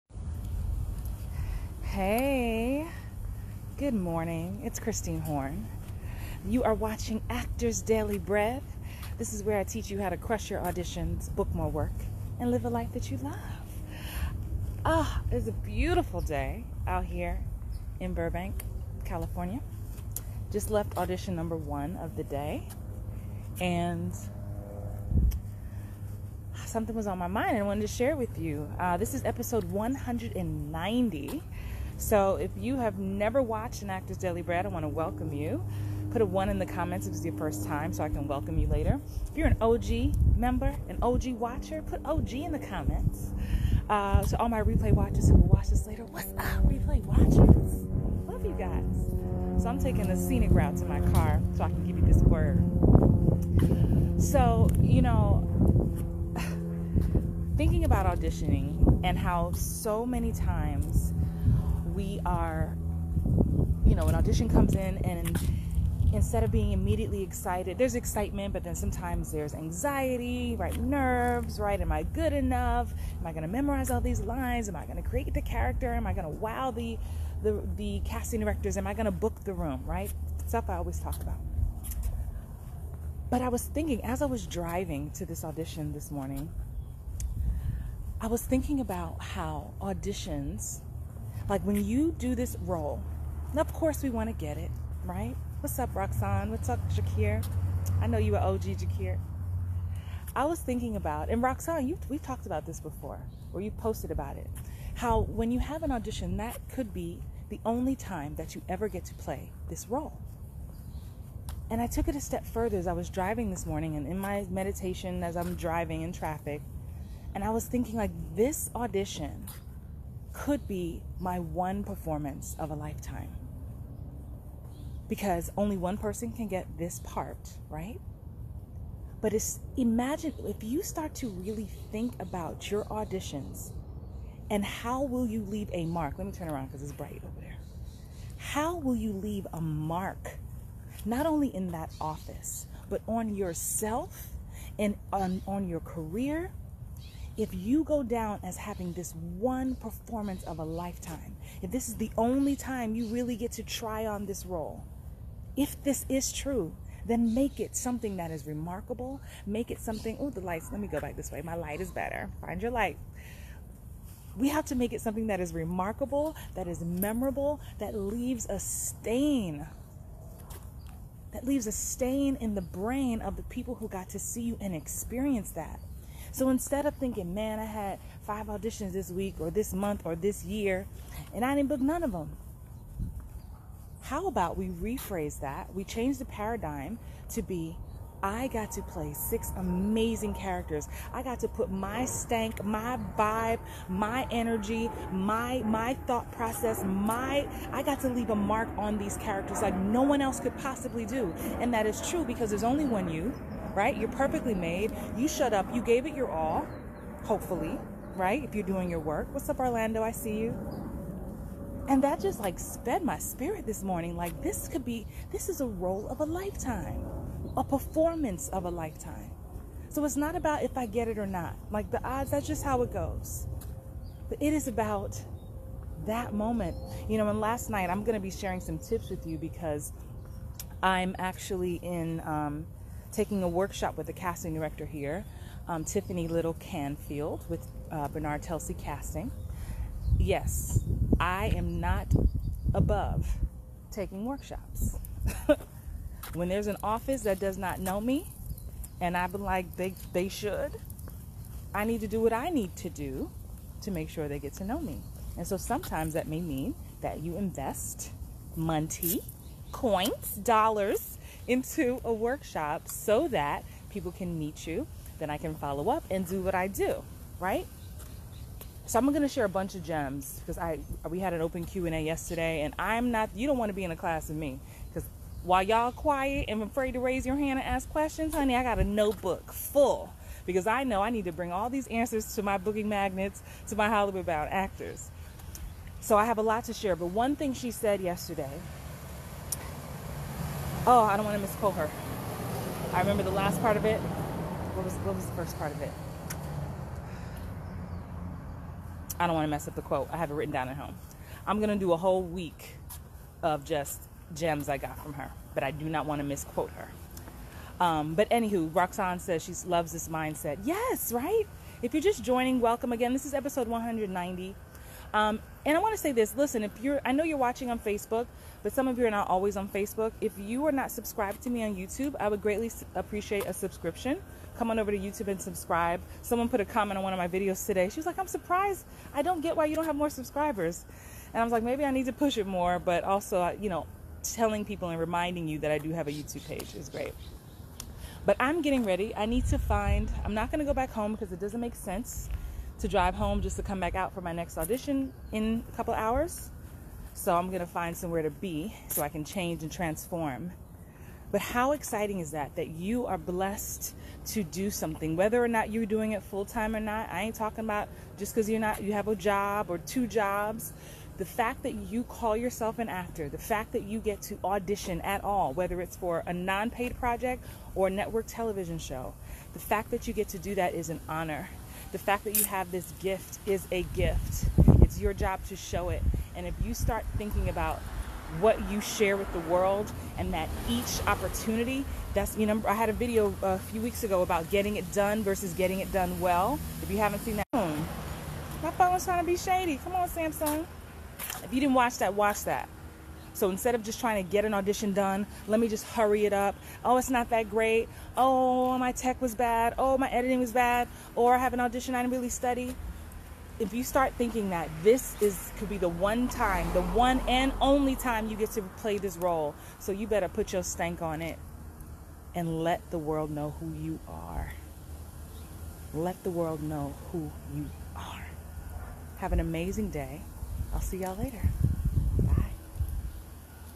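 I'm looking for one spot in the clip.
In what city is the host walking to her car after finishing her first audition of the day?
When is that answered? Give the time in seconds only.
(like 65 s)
18 s.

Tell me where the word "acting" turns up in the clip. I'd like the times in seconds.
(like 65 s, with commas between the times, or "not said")
not said.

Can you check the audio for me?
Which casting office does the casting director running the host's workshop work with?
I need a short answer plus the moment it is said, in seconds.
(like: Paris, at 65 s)
Bernard Telsey Casting, at 238 s.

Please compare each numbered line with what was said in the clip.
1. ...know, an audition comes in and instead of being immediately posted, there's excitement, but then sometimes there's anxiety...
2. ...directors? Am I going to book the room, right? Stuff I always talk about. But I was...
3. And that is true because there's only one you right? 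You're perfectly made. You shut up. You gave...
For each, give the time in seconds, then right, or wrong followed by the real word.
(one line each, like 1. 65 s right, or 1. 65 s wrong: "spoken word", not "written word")
1. 63 s wrong: "excited", not "posted"
2. 78 s right
3. 201 s right.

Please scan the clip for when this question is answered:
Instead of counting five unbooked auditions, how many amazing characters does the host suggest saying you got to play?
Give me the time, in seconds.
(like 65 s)
189 s.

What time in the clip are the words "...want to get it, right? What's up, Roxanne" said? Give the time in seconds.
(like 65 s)
94 s.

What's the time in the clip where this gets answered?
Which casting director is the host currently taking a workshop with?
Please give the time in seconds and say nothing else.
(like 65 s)
235 s.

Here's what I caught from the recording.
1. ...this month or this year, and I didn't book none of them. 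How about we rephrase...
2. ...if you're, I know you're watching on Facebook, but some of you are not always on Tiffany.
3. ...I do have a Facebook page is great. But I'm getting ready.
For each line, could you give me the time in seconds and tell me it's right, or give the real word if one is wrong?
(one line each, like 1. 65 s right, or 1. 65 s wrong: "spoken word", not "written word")
1. 179 s right
2. 316 s wrong: "Facebook", not "Tiffany"
3. 335 s wrong: "YouTube", not "Facebook".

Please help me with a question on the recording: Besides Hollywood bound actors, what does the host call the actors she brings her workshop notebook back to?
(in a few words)
booking magnets.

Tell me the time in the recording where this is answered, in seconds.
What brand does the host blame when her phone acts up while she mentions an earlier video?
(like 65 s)
390 s.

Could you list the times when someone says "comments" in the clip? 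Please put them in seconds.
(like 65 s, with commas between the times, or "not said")
36 s, 42 s, 326 s.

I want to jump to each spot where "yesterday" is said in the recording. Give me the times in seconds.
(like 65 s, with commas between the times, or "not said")
272 s, 288 s.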